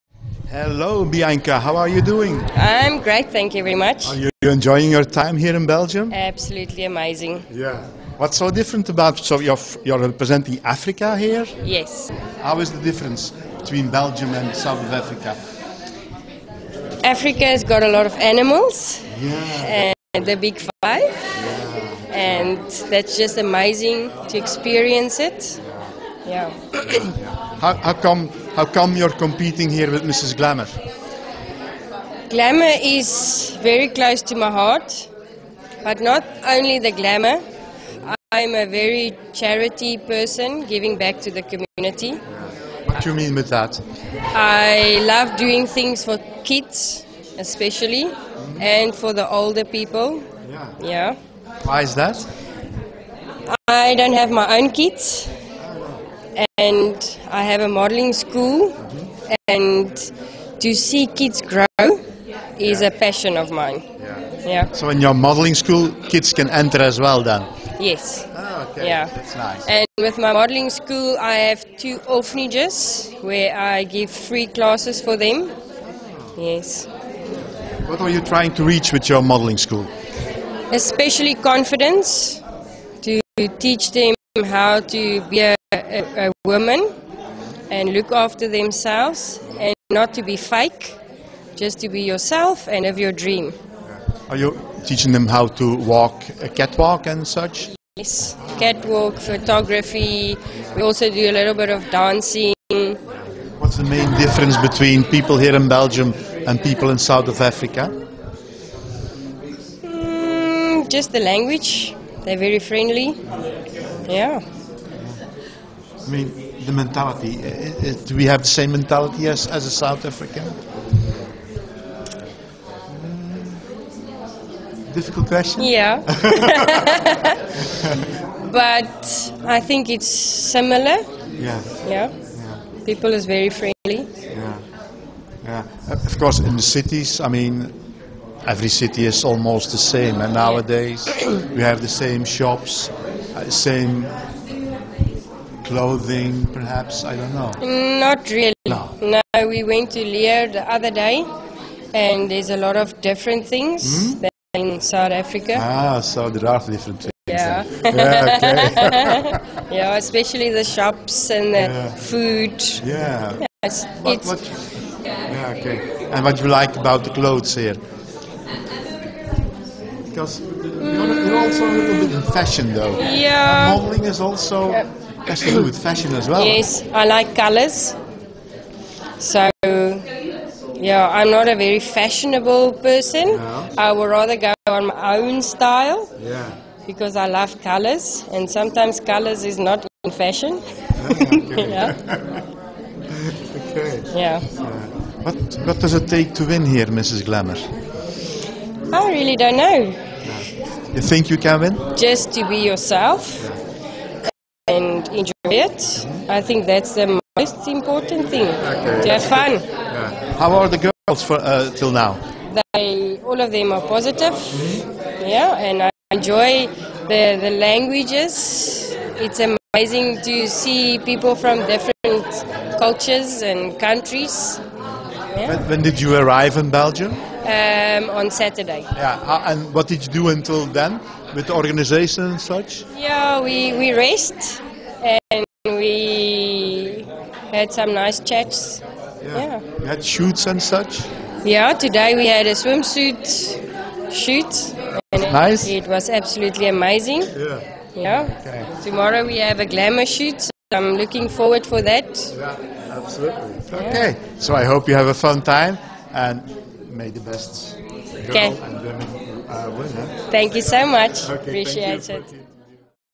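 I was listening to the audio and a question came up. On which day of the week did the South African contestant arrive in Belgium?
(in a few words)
Saturday.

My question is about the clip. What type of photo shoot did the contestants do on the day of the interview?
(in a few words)
Swimsuit shoot.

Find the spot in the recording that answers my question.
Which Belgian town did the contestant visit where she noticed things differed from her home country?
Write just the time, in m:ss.
2:30.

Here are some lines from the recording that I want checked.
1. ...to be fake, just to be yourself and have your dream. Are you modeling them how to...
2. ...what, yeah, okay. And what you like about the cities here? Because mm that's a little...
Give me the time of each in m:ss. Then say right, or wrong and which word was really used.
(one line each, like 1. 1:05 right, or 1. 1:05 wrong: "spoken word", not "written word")
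1. 1:30 wrong: "teaching", not "modeling"
2. 2:44 wrong: "clothes", not "cities".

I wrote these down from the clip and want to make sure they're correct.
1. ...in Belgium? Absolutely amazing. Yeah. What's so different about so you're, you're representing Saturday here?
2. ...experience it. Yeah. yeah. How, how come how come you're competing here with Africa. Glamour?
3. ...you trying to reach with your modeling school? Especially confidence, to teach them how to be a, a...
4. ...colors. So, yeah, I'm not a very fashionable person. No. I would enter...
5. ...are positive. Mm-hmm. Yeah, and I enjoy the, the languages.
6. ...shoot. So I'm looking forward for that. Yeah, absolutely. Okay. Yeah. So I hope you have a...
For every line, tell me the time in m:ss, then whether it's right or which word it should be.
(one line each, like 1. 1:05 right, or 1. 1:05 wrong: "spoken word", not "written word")
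1. 0:05 wrong: "Africa", not "Saturday"
2. 0:24 wrong: "Mrs", not "Africa"
3. 1:18 right
4. 2:57 wrong: "rather", not "enter"
5. 3:33 right
6. 4:10 right.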